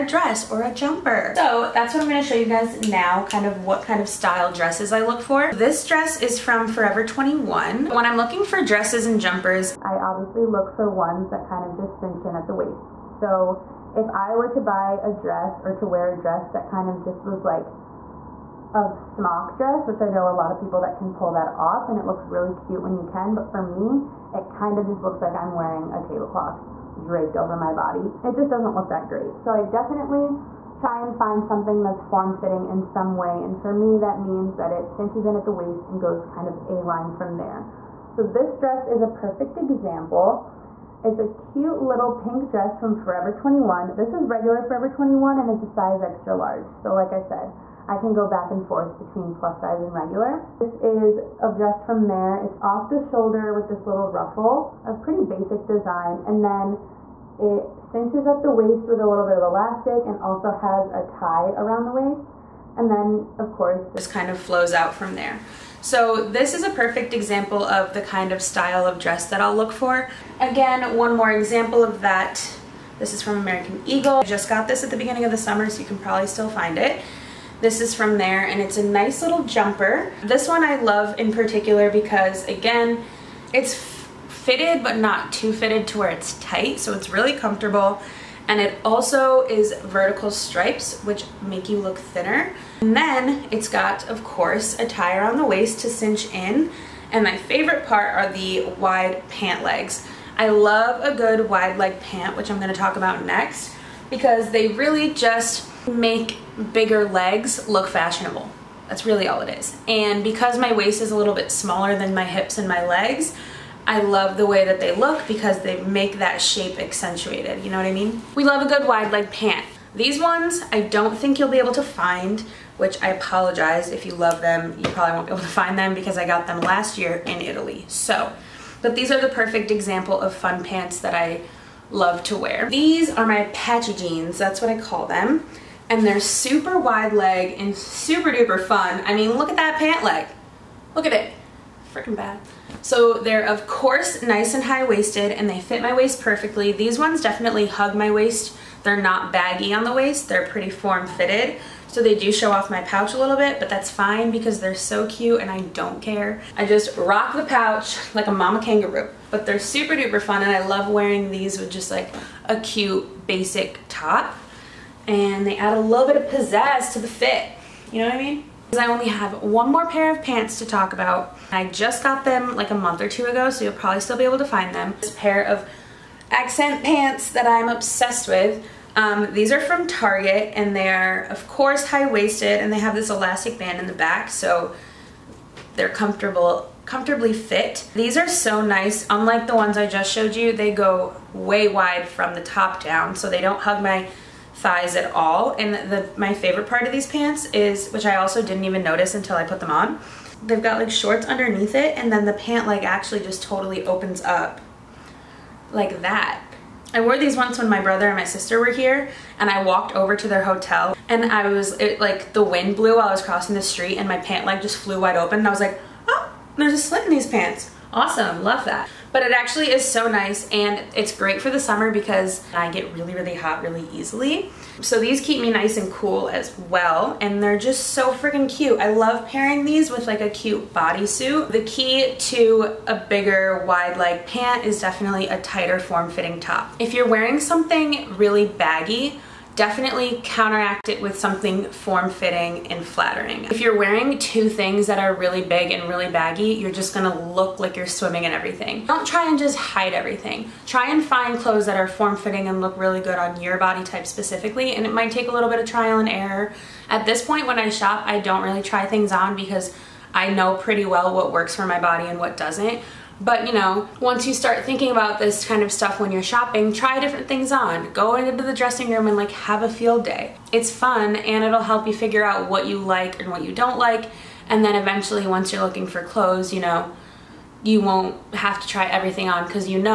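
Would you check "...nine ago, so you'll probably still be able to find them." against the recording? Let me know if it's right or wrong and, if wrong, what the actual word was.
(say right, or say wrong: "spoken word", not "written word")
wrong: "two", not "nine".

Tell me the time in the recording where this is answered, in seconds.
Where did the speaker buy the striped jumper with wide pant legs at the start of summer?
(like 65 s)
73 s.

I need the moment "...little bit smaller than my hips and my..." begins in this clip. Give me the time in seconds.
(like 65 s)
111 s.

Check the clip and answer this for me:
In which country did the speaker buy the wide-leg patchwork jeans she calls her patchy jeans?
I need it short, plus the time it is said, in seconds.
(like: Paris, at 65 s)
Italy, at 127 s.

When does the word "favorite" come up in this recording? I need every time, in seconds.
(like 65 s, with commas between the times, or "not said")
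97 s, 196 s.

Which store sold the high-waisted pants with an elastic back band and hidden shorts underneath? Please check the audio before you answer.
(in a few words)
Target.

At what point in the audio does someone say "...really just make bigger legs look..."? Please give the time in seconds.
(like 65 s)
104 s.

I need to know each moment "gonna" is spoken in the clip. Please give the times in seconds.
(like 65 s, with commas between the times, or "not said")
2 s, 246 s.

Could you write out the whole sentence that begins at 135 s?
And they're super wide leg and super duper fun.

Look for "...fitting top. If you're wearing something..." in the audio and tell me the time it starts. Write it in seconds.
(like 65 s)
236 s.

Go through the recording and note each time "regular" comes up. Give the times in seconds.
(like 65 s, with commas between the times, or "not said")
44 s, 49 s.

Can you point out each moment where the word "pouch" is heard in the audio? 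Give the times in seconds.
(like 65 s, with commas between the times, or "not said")
152 s, 157 s.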